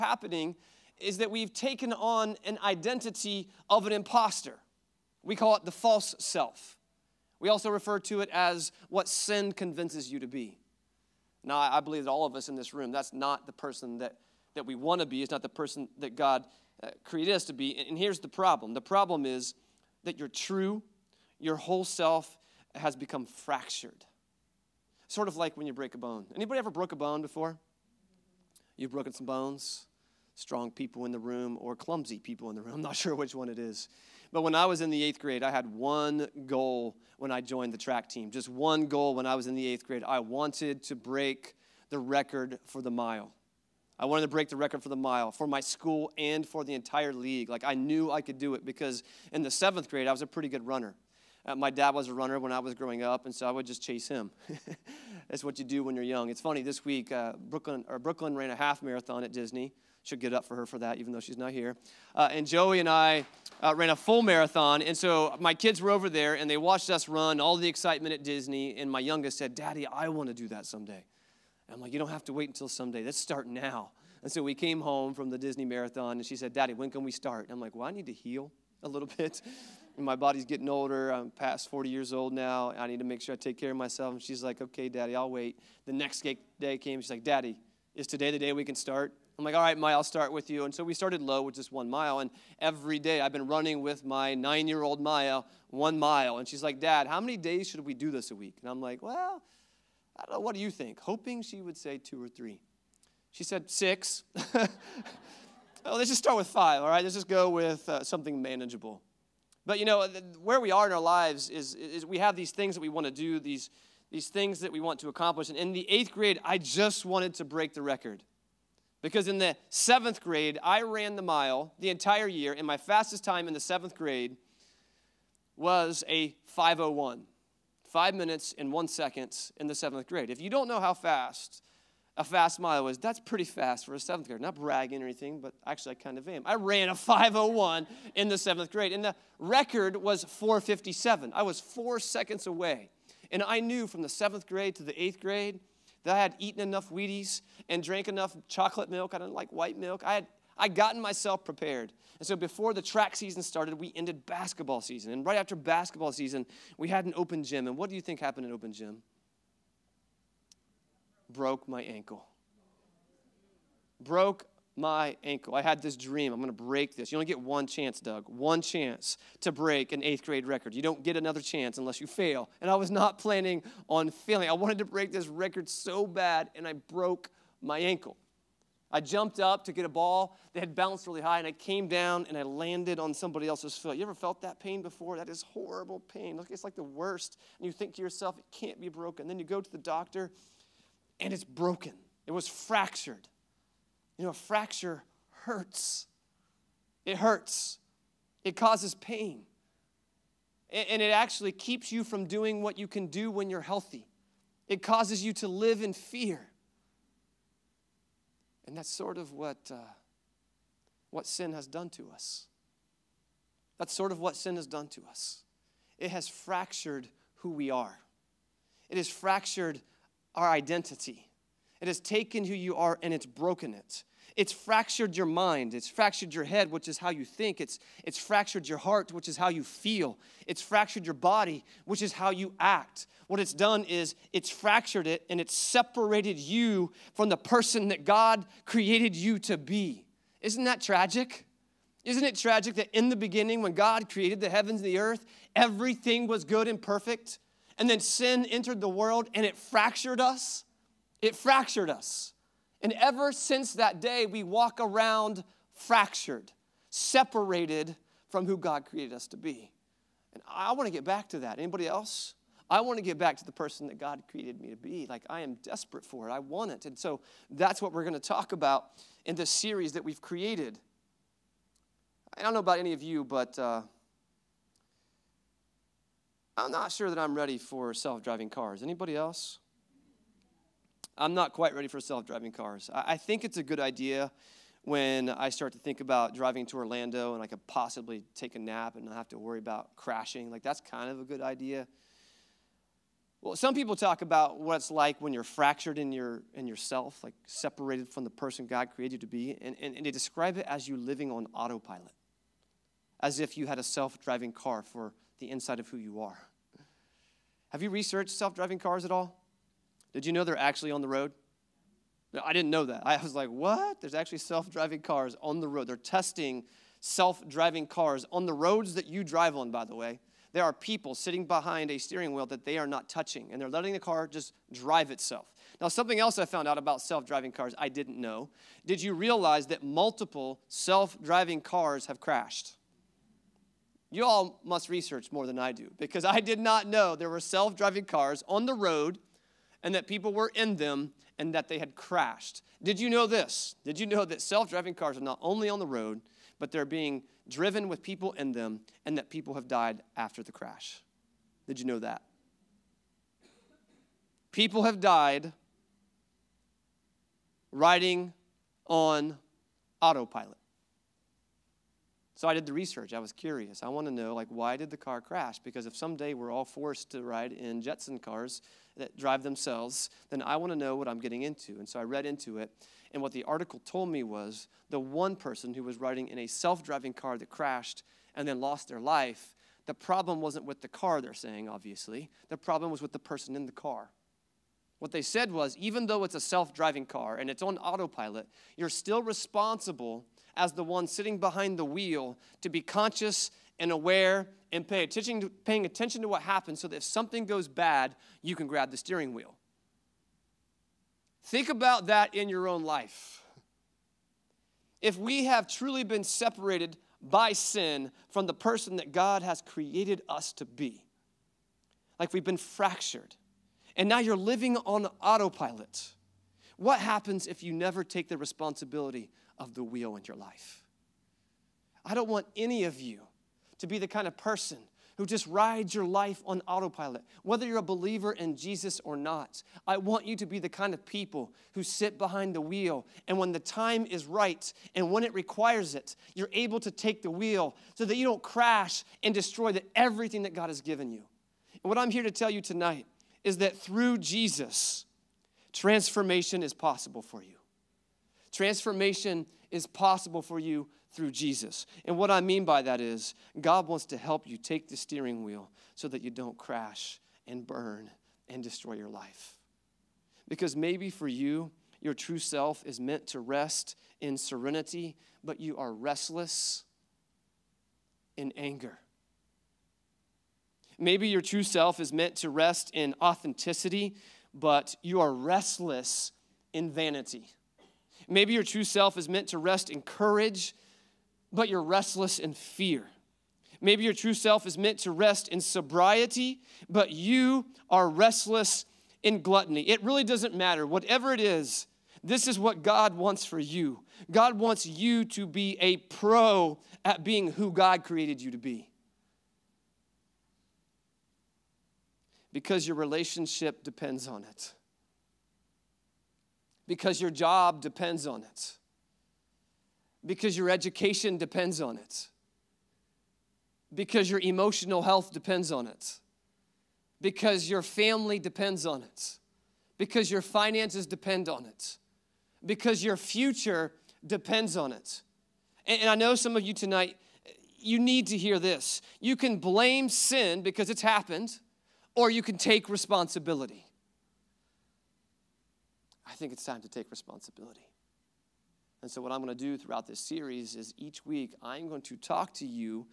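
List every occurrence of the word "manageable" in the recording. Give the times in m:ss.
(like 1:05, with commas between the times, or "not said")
1:48.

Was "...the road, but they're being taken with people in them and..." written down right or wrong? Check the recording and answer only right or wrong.
wrong.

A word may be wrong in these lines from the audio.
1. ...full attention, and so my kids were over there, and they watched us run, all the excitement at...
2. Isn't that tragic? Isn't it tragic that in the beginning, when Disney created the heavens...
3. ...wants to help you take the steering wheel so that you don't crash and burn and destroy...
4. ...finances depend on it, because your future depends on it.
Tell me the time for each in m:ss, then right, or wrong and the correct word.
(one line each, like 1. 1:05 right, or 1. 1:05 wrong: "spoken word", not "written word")
1. 1:03 wrong: "marathon", not "attention"
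2. 4:00 wrong: "God", not "Disney"
3. 7:33 right
4. 8:40 right.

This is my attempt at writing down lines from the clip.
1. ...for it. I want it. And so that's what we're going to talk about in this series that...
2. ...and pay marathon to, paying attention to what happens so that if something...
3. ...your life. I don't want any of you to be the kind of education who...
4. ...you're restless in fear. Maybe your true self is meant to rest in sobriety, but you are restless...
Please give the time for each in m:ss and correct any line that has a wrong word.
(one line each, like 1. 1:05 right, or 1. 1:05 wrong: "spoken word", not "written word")
1. 4:26 right
2. 6:34 wrong: "attention", not "marathon"
3. 7:00 wrong: "person", not "education"
4. 8:01 right.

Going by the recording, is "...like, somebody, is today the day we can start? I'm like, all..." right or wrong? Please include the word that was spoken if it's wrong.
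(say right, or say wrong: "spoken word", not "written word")
wrong: "daddy", not "somebody".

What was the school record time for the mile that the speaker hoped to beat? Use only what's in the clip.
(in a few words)
4:57.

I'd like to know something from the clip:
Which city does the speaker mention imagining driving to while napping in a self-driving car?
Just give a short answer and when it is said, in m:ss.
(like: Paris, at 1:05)
Orlando, at 4:46.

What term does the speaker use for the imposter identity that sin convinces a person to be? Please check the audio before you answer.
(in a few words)
the false self.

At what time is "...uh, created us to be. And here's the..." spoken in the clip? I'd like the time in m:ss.
0:16.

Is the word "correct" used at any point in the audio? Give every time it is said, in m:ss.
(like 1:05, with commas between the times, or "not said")
not said.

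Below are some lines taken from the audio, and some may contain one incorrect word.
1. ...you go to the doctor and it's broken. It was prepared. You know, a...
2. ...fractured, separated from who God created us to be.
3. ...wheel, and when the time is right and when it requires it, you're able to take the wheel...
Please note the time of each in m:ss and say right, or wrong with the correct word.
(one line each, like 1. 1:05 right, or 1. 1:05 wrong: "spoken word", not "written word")
1. 3:09 wrong: "fractured", not "prepared"
2. 4:15 right
3. 7:12 right.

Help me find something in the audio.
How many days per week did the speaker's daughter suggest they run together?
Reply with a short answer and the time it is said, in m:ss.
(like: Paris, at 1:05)
6, at 1:43.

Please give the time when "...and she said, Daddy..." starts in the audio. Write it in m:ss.
1:16.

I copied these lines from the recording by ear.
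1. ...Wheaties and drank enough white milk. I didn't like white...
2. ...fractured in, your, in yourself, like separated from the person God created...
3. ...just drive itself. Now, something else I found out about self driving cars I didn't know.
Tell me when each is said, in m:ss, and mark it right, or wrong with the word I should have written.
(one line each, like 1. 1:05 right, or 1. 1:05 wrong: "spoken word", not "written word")
1. 2:26 wrong: "chocolate", not "white"
2. 4:55 right
3. 5:24 right.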